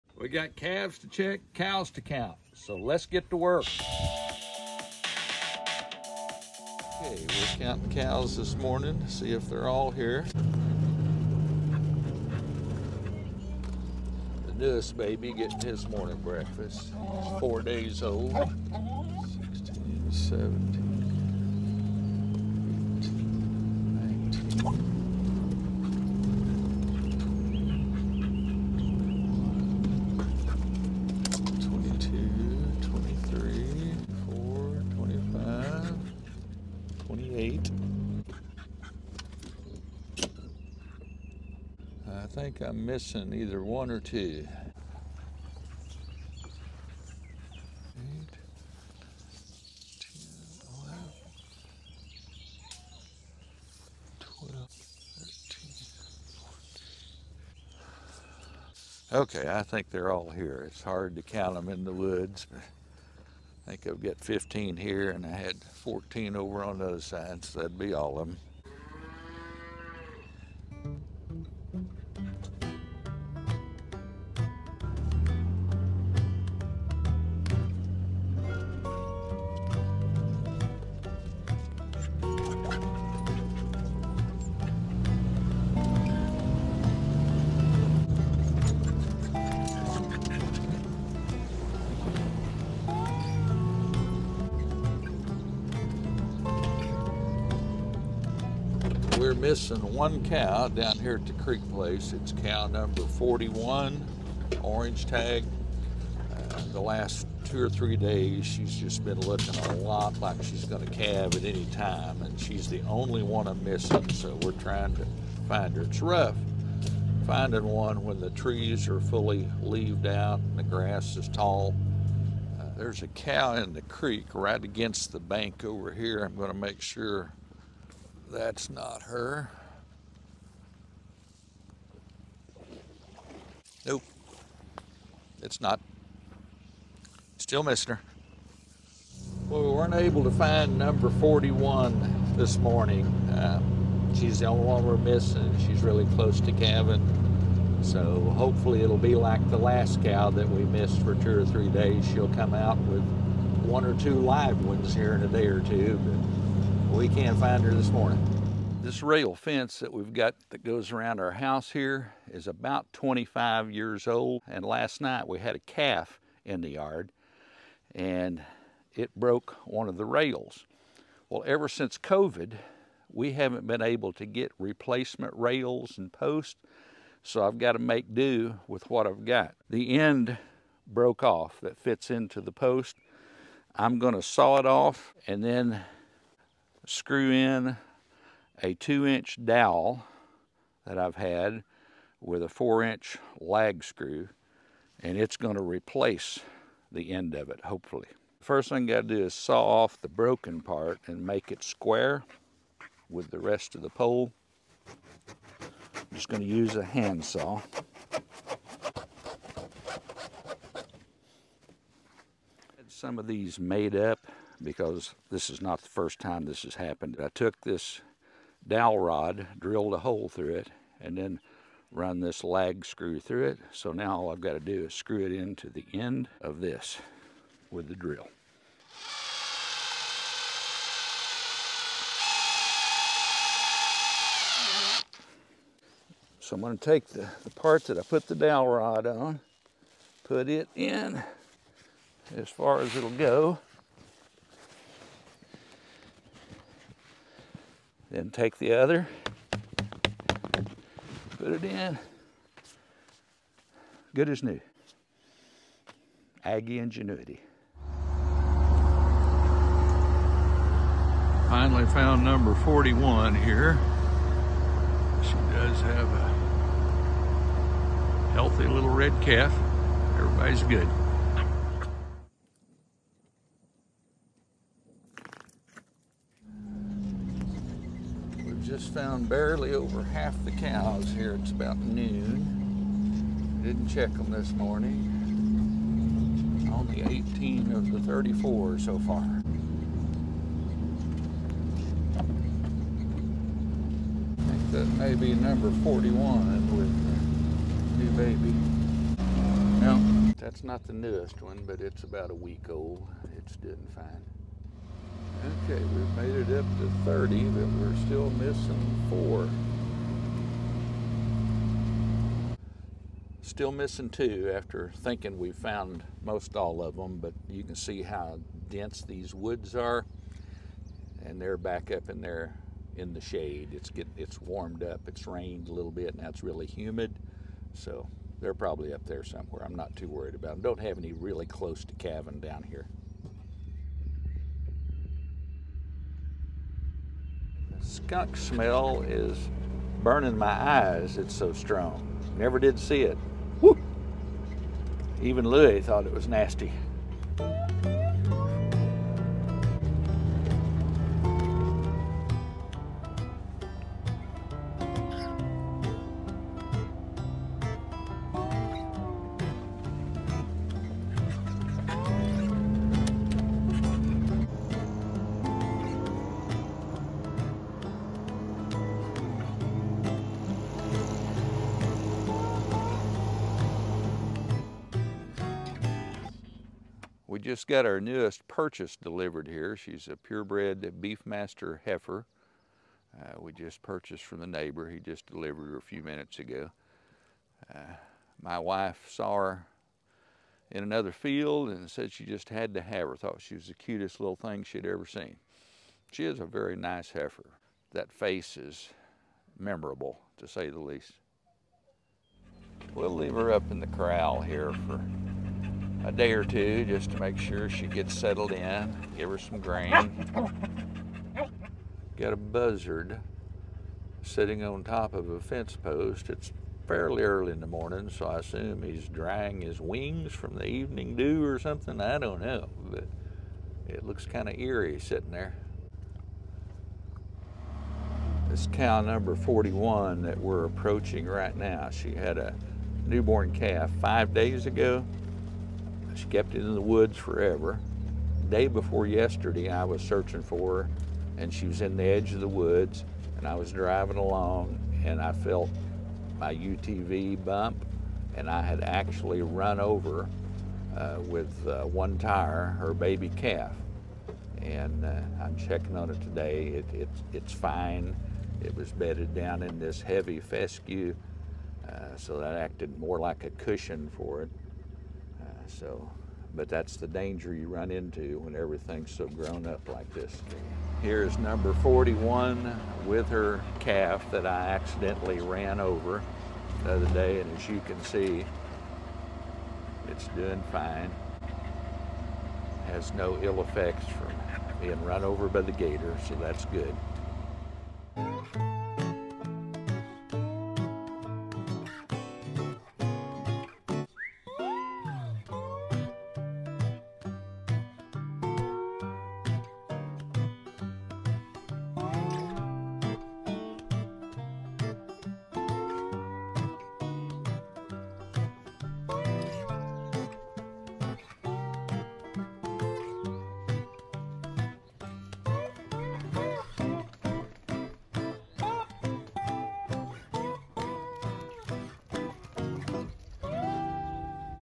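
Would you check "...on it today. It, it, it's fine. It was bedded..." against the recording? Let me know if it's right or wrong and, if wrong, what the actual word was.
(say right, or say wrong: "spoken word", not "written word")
right.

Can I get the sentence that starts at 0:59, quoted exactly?
okay, I think they're all here.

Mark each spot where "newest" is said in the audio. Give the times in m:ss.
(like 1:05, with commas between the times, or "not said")
0:14, 5:00, 6:17.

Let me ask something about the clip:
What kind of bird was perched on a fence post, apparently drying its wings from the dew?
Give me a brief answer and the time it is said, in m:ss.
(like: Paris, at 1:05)
Buzzard, at 6:52.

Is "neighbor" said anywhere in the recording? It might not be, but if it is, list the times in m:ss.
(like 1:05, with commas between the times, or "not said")
6:24.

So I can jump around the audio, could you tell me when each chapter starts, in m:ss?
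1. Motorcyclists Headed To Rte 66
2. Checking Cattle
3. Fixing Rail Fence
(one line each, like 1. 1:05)
1. 8:07
2. 4:18
3. 2:39.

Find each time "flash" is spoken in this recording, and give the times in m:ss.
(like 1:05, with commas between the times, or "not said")
not said.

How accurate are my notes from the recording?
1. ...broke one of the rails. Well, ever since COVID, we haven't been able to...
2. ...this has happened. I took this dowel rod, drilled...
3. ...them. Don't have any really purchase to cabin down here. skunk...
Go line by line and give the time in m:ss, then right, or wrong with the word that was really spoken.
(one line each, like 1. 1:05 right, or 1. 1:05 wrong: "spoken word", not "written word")
1. 2:49 right
2. 3:36 right
3. 5:30 wrong: "close", not "purchase".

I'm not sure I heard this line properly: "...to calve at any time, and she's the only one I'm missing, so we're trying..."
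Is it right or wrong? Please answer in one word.
right.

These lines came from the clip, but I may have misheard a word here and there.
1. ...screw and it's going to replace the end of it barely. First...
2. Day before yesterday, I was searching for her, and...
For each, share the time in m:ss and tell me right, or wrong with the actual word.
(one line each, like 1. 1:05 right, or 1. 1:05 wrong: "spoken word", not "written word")
1. 3:13 wrong: "hopefully", not "barely"
2. 7:18 right.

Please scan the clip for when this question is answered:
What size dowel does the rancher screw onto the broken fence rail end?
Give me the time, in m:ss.
3:08.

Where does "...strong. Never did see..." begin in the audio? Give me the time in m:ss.
5:41.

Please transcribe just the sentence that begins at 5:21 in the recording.
And they're back up in there in the shade.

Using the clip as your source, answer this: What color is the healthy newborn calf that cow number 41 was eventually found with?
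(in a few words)
Red.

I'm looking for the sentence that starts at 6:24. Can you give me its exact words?
He just delivered her a few minutes ago.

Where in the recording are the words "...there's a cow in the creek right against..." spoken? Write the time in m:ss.
2:02.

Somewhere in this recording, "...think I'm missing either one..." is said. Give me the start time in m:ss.
0:42.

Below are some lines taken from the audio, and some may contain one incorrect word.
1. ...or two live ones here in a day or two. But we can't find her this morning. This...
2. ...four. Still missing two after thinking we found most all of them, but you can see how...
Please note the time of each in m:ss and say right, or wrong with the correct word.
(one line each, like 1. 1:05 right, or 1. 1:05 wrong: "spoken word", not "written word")
1. 2:33 right
2. 5:09 right.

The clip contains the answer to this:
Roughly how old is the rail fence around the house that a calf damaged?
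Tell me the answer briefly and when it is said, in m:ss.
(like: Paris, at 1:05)
25, at 2:42.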